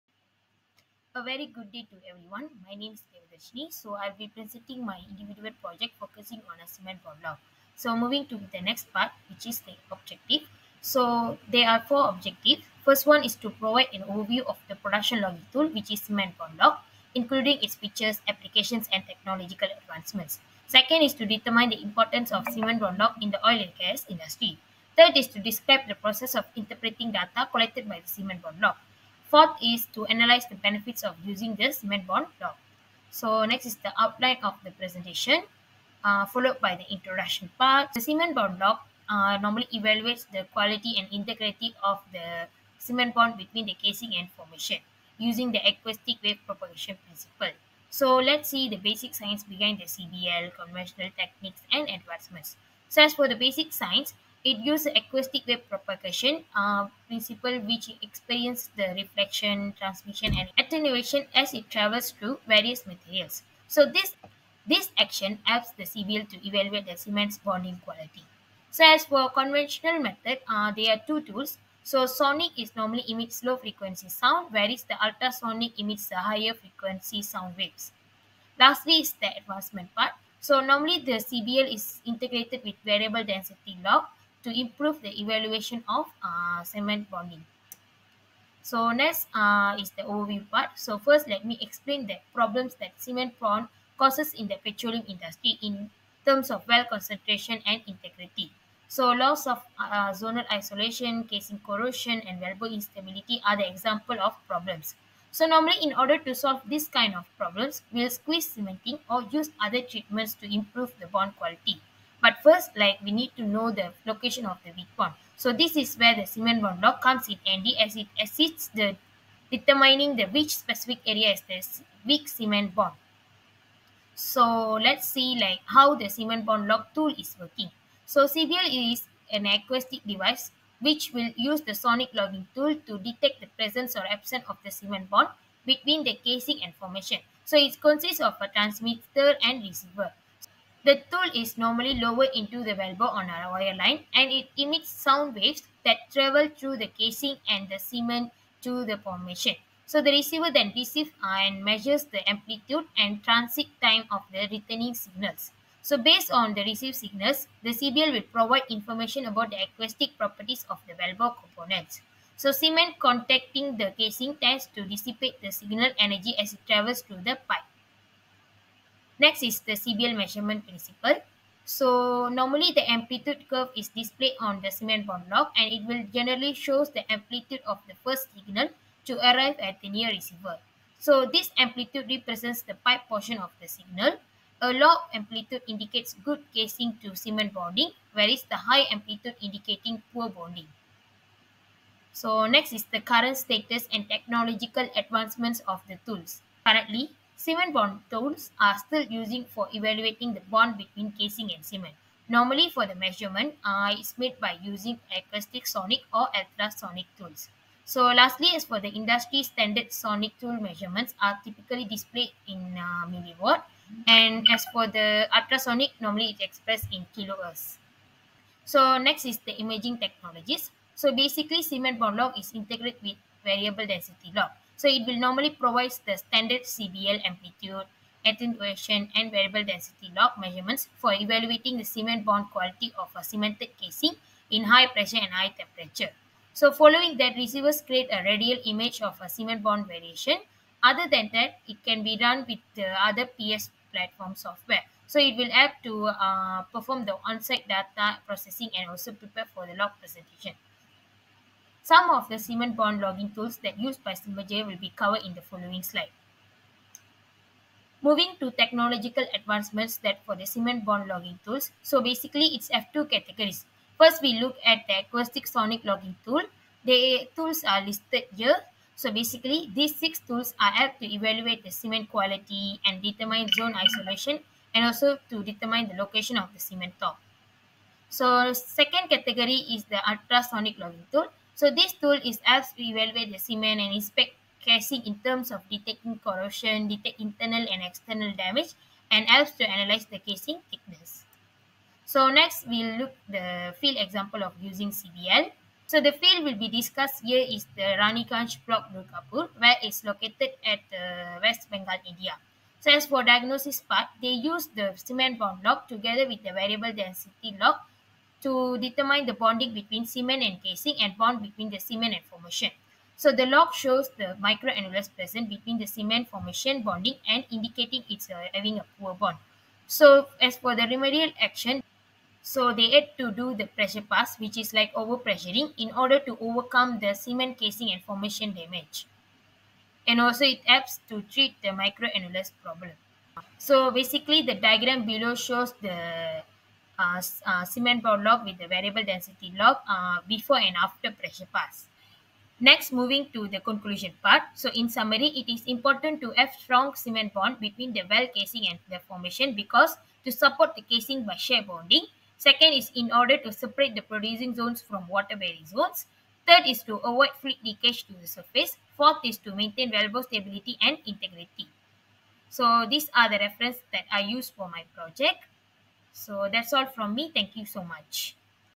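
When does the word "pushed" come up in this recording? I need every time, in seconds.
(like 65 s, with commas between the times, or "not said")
not said.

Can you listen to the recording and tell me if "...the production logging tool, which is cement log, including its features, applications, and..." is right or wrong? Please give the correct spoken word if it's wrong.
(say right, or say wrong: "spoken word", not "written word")
right.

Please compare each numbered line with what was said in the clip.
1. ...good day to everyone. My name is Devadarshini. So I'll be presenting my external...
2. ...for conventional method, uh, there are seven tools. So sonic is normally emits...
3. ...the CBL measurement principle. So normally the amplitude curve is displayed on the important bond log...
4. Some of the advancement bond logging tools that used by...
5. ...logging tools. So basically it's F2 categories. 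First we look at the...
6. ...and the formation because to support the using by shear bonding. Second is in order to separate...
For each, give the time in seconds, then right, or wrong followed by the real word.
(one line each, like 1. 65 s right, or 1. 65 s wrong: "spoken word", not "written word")
1. 1 s wrong: "individual", not "external"
2. 69 s wrong: "two", not "seven"
3. 169 s wrong: "cement", not "important"
4. 251 s wrong: "cement", not "advancement"
5. 261 s right
6. 348 s wrong: "casing", not "using".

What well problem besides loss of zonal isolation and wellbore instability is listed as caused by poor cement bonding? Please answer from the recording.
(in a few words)
Casing corrosion.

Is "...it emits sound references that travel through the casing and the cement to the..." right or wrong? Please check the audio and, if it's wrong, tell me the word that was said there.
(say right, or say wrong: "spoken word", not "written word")
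wrong: "waves", not "references".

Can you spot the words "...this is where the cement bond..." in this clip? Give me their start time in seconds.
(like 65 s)
115 s.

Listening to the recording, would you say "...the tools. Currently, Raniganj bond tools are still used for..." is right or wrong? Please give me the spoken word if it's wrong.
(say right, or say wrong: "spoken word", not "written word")
wrong: "Cement", not "Raniganj".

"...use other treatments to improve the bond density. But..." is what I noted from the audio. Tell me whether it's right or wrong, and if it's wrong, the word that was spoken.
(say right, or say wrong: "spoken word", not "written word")
wrong: "quality", not "density".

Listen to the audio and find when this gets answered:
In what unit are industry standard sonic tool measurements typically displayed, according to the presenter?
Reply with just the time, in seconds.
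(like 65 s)
213 s.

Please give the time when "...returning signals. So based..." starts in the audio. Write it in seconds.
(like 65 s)
154 s.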